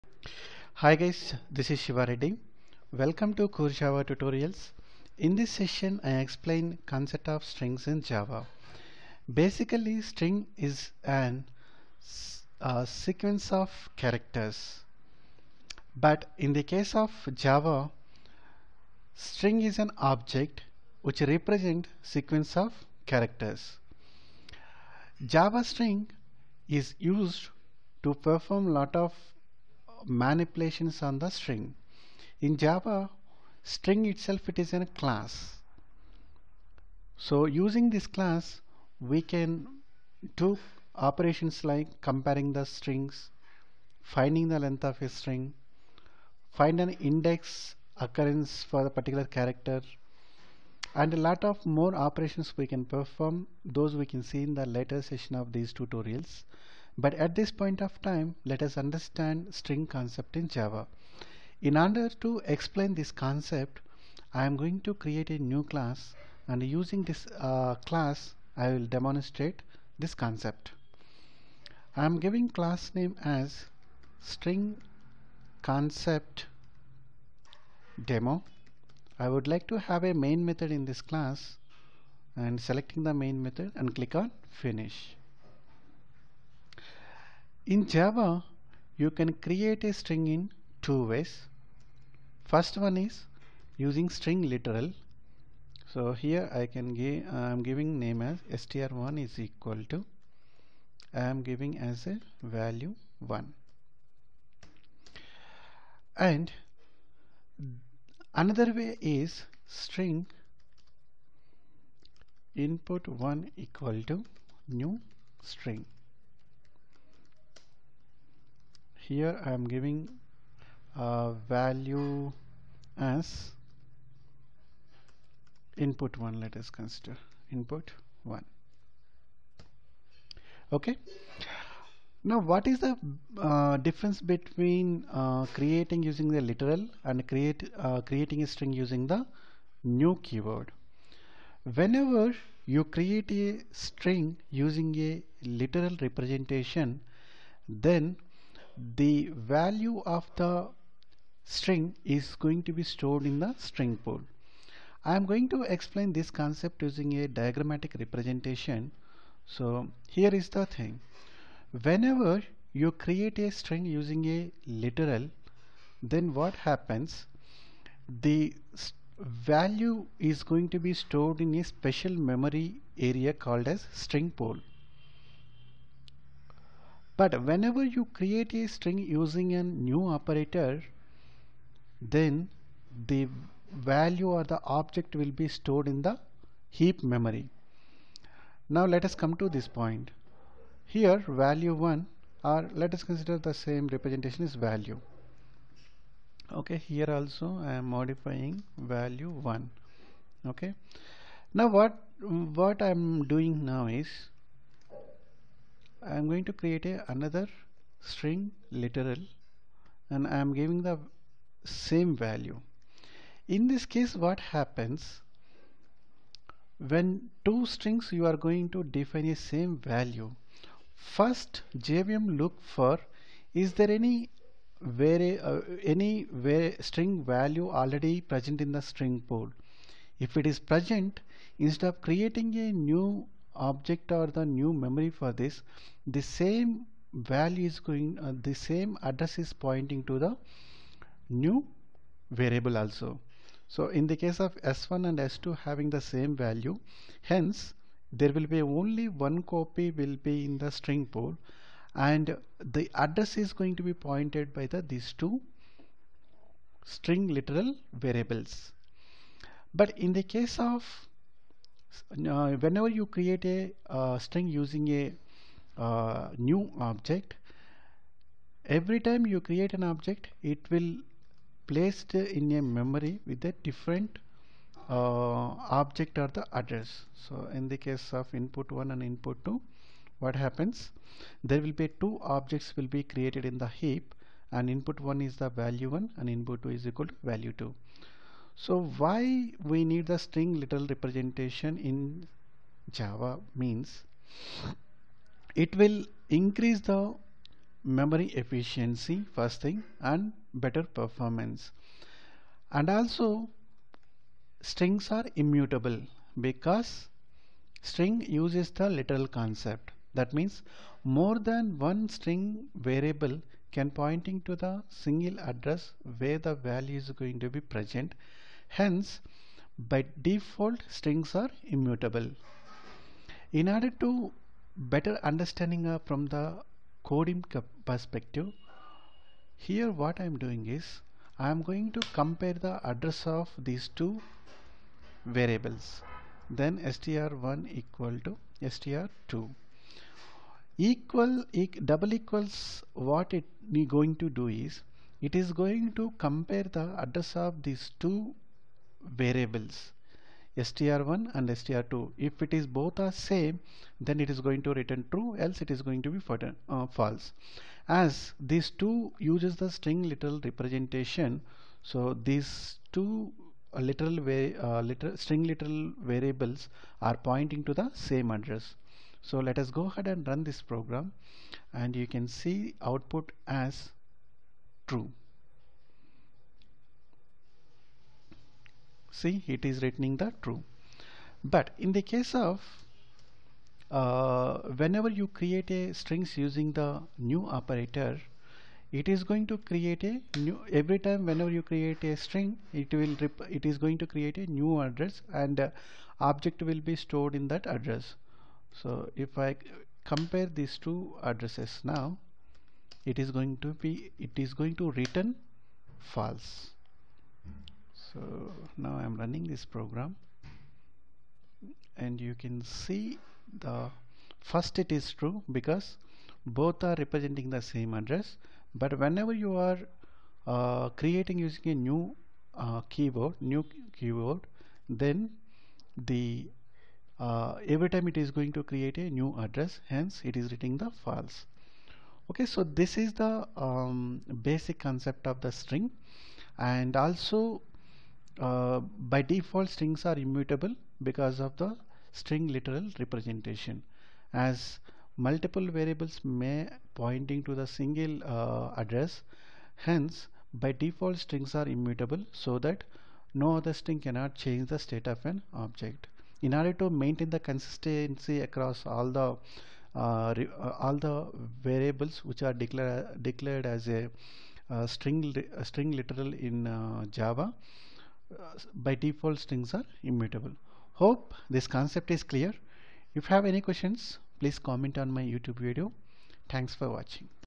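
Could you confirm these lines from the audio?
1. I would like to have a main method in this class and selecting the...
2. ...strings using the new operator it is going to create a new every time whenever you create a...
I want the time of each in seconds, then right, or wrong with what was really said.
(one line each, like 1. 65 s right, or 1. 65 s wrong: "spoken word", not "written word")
1. 79 s right
2. 385 s right.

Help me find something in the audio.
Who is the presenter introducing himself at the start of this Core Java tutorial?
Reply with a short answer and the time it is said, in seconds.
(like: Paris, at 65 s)
Siva Reddy, at 1 s.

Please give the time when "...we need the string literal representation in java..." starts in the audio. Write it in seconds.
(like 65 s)
289 s.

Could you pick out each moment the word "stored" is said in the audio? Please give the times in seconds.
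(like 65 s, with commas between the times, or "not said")
152 s, 170 s, 185 s, 396 s.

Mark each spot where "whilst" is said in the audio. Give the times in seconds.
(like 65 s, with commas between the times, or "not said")
not said.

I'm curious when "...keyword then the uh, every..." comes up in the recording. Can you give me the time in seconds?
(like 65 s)
423 s.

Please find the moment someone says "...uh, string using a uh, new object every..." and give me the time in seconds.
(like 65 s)
263 s.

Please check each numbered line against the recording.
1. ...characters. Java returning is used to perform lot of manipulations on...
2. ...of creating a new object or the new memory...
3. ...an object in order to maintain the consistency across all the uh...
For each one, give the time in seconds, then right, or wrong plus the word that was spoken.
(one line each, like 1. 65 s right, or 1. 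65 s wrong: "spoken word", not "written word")
1. 23 s wrong: "string", not "returning"
2. 231 s right
3. 455 s right.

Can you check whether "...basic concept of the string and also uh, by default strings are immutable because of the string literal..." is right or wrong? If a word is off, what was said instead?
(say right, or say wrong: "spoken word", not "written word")
right.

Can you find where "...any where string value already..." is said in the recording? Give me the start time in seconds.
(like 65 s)
225 s.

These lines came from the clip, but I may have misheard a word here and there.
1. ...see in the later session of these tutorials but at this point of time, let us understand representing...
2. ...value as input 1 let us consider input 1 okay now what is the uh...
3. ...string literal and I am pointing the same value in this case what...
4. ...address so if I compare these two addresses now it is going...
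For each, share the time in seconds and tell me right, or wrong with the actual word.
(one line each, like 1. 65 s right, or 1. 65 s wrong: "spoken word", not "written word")
1. 54 s wrong: "string", not "representing"
2. 121 s right
3. 207 s wrong: "giving", not "pointing"
4. 397 s right.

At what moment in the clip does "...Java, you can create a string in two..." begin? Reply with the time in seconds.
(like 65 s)
87 s.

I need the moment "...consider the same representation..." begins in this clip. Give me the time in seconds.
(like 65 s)
193 s.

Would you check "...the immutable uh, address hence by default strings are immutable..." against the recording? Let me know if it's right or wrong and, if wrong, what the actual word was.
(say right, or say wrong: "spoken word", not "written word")
wrong: "single", not "immutable".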